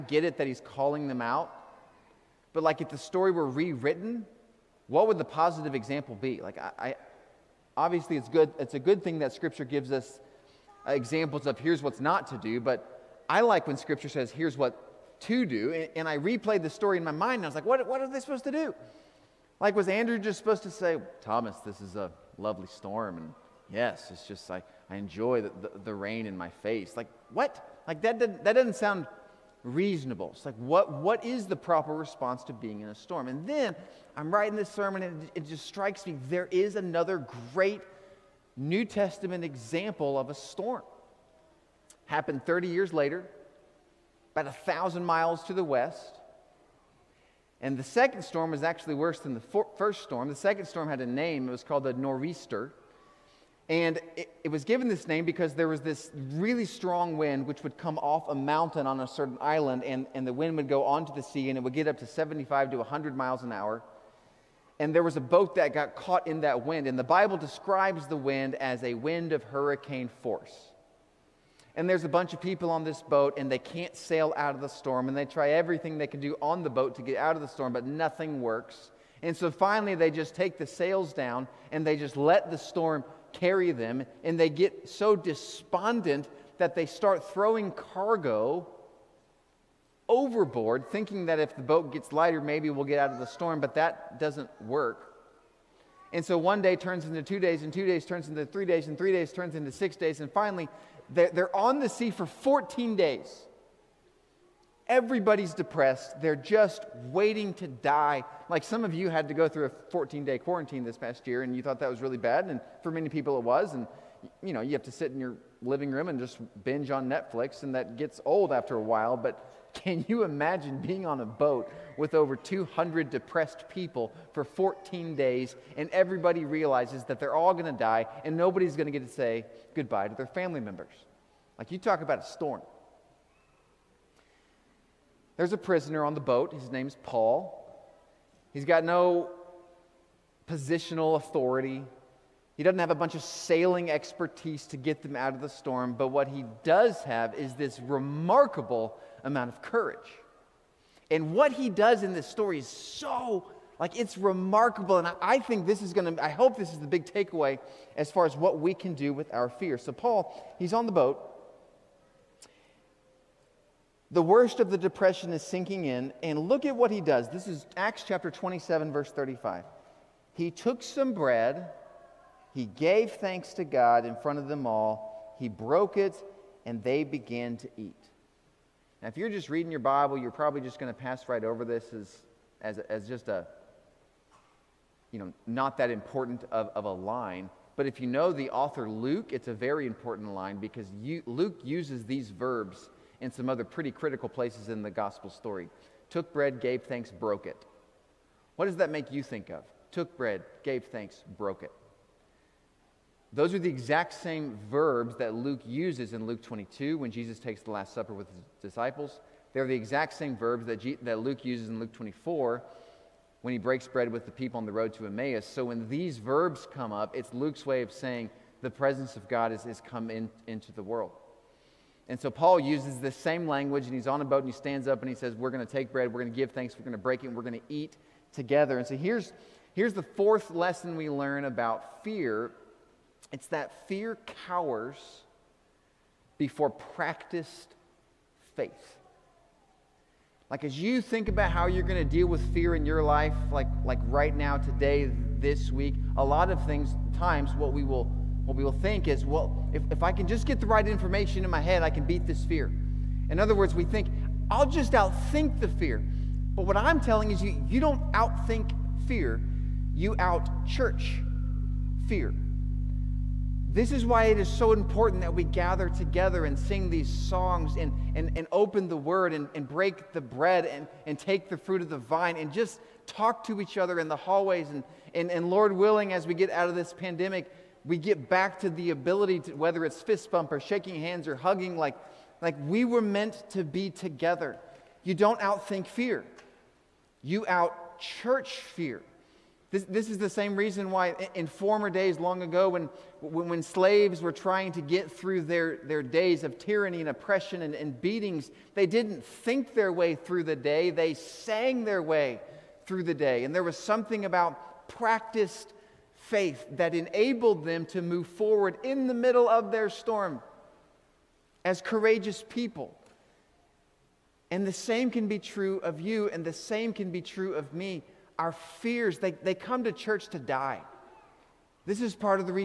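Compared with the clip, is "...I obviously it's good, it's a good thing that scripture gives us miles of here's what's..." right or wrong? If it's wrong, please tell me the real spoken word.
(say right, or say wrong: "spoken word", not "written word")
wrong: "examples", not "miles".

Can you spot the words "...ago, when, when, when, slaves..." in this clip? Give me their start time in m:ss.
4:52.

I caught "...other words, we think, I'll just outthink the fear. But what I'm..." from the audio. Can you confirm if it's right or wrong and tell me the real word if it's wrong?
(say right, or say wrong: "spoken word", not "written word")
right.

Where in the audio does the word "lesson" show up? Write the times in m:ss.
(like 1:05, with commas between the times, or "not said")
3:50.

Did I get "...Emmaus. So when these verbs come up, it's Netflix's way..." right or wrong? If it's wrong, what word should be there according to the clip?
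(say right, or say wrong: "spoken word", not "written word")
wrong: "Luke", not "Netflix".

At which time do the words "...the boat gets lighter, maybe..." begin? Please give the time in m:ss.
1:31.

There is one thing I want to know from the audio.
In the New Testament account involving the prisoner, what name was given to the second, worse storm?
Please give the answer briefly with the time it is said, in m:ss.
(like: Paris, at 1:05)
nor'easter, at 0:51.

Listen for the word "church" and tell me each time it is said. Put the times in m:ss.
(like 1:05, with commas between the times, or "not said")
4:20, 4:48, 5:19.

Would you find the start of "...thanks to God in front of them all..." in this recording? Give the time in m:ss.
2:53.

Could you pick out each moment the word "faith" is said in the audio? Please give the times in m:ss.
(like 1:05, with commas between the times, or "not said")
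3:58, 5:06.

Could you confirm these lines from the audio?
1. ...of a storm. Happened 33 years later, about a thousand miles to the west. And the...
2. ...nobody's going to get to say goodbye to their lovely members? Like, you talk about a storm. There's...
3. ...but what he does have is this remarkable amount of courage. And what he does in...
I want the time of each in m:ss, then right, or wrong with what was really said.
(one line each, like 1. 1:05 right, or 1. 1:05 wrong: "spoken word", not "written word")
1. 0:40 wrong: "30", not "33"
2. 2:08 wrong: "family", not "lovely"
3. 2:25 right.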